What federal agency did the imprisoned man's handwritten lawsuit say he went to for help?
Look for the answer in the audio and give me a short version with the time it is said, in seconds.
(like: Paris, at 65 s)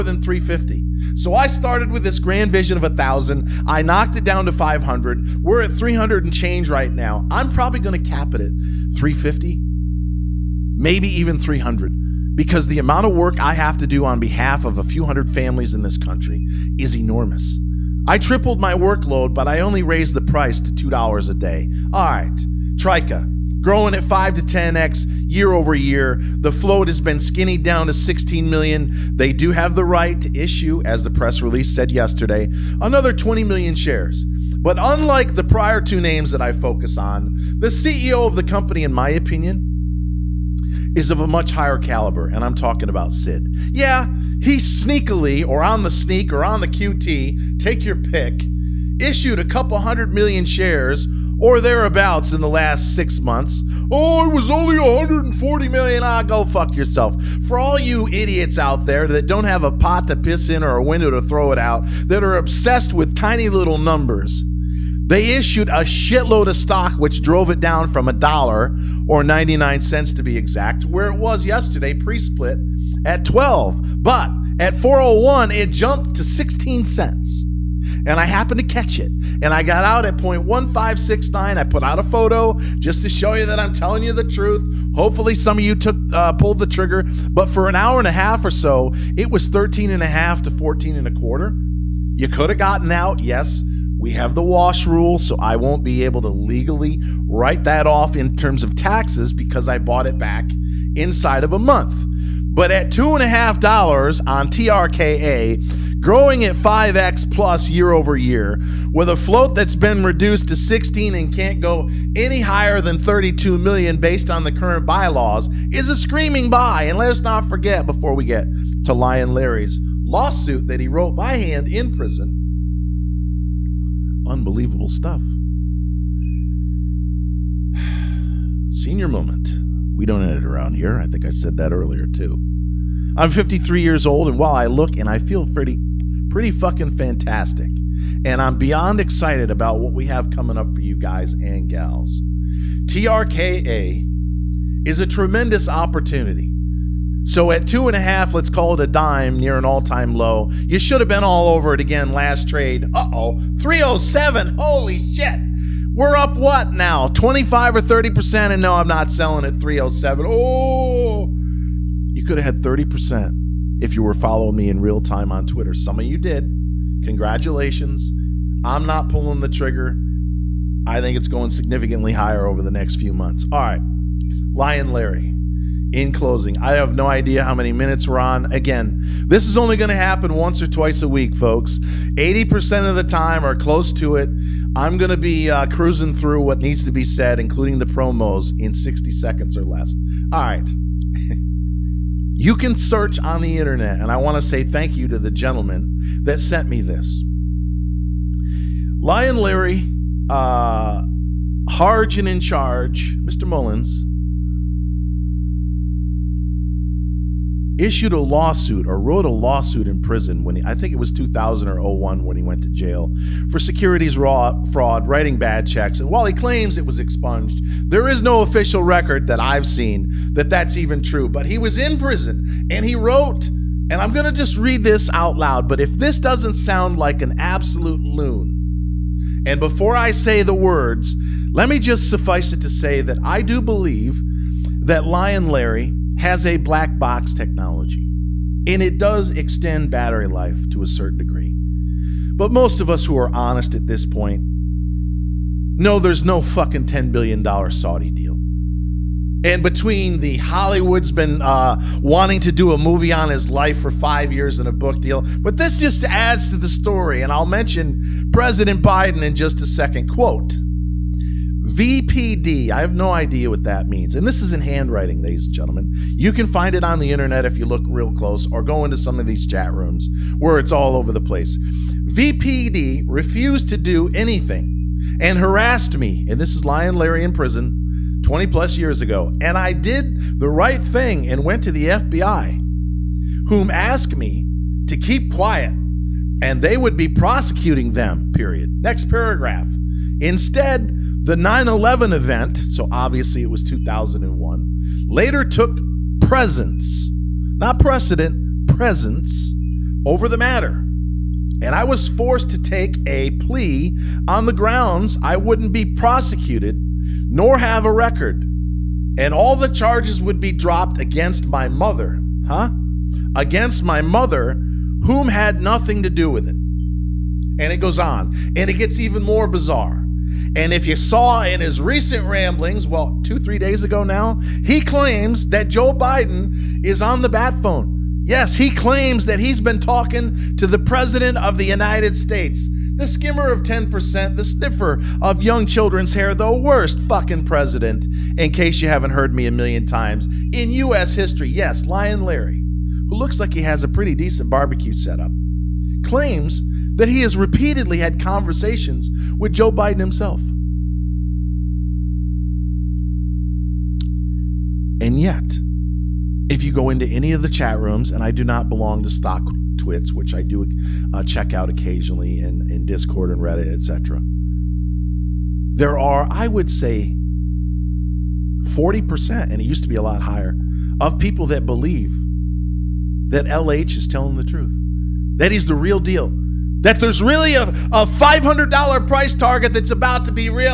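FBI, at 281 s.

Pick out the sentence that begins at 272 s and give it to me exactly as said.
VPD refused to do anything and harassed me.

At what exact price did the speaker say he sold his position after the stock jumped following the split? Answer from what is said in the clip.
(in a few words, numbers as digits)
0.1569.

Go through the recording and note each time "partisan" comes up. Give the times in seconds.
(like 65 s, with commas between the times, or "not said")
not said.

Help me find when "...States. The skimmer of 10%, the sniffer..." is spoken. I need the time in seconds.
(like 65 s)
332 s.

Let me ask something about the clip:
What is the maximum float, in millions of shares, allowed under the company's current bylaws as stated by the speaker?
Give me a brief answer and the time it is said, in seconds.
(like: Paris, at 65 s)
32 million, at 112 s.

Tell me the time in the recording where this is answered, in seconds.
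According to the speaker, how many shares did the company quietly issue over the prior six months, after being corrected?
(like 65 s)
54 s.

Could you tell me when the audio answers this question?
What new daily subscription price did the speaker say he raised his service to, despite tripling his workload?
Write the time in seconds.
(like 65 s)
20 s.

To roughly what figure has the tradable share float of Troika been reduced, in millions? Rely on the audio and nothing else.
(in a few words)
16 million.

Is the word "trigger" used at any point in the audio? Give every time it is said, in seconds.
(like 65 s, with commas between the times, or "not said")
86 s, 169 s.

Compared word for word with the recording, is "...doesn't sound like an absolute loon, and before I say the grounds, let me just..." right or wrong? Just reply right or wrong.
wrong.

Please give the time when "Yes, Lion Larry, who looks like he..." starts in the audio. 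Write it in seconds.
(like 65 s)
341 s.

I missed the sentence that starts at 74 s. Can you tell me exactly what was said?
But at 401, it jumped to 16 cents.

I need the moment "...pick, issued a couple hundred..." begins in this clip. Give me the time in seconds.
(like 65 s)
47 s.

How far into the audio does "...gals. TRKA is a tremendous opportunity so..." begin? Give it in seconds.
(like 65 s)
141 s.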